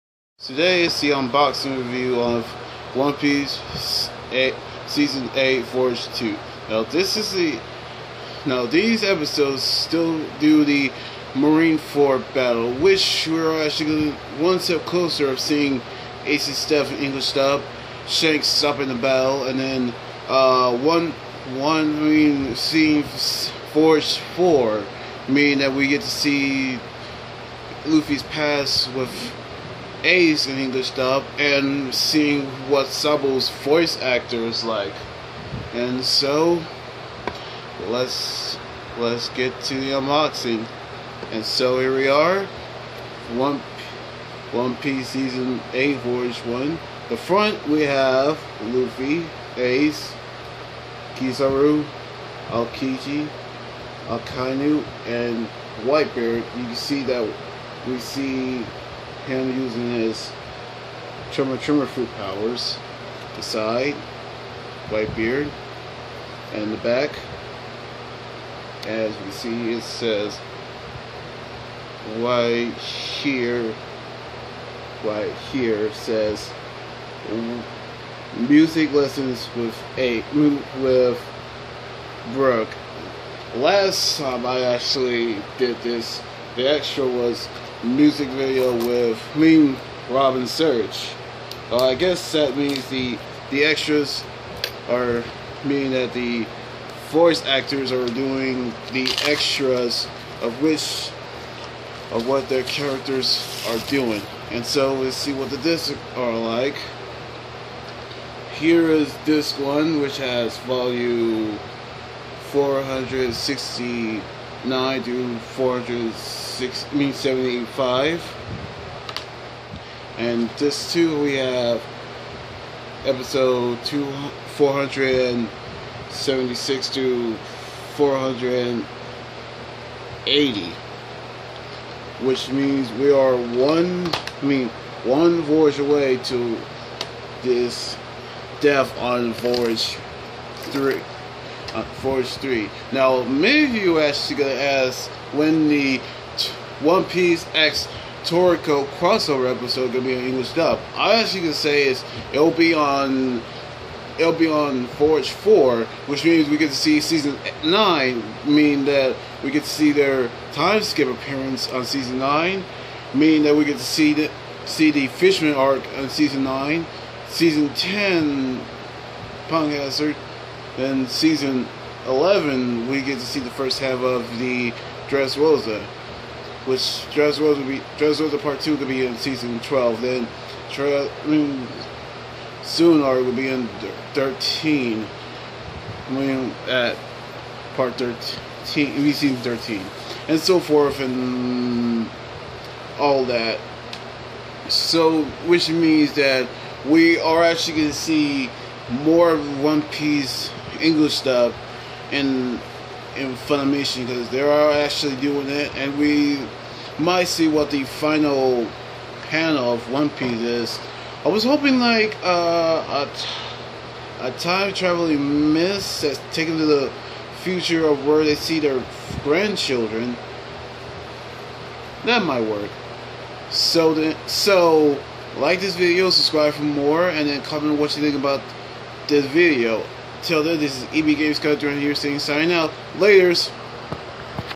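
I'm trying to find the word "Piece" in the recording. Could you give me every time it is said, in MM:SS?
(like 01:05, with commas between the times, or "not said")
00:03, 00:44, 02:27, 03:19, 03:30.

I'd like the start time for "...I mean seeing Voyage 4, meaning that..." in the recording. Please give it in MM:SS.
00:21.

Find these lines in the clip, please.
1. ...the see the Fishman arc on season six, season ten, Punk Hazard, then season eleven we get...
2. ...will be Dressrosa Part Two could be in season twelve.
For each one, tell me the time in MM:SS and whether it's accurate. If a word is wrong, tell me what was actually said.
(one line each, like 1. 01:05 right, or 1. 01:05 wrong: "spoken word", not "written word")
1. 02:44 wrong: "nine", not "six"
2. 02:57 right.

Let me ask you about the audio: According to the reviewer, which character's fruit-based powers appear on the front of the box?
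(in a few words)
Whitebeard.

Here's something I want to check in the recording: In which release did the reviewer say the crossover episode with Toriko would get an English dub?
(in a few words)
Voyage Four.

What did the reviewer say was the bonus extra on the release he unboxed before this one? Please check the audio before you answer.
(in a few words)
music video.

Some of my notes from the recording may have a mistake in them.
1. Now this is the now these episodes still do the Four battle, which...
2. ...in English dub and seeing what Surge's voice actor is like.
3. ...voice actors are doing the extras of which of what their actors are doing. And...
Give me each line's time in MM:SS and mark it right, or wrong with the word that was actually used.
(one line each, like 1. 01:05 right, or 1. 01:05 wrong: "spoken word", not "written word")
1. 00:06 wrong: "Marineford", not "Four"
2. 00:30 wrong: "Sabo", not "Surge"
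3. 01:37 wrong: "characters", not "actors".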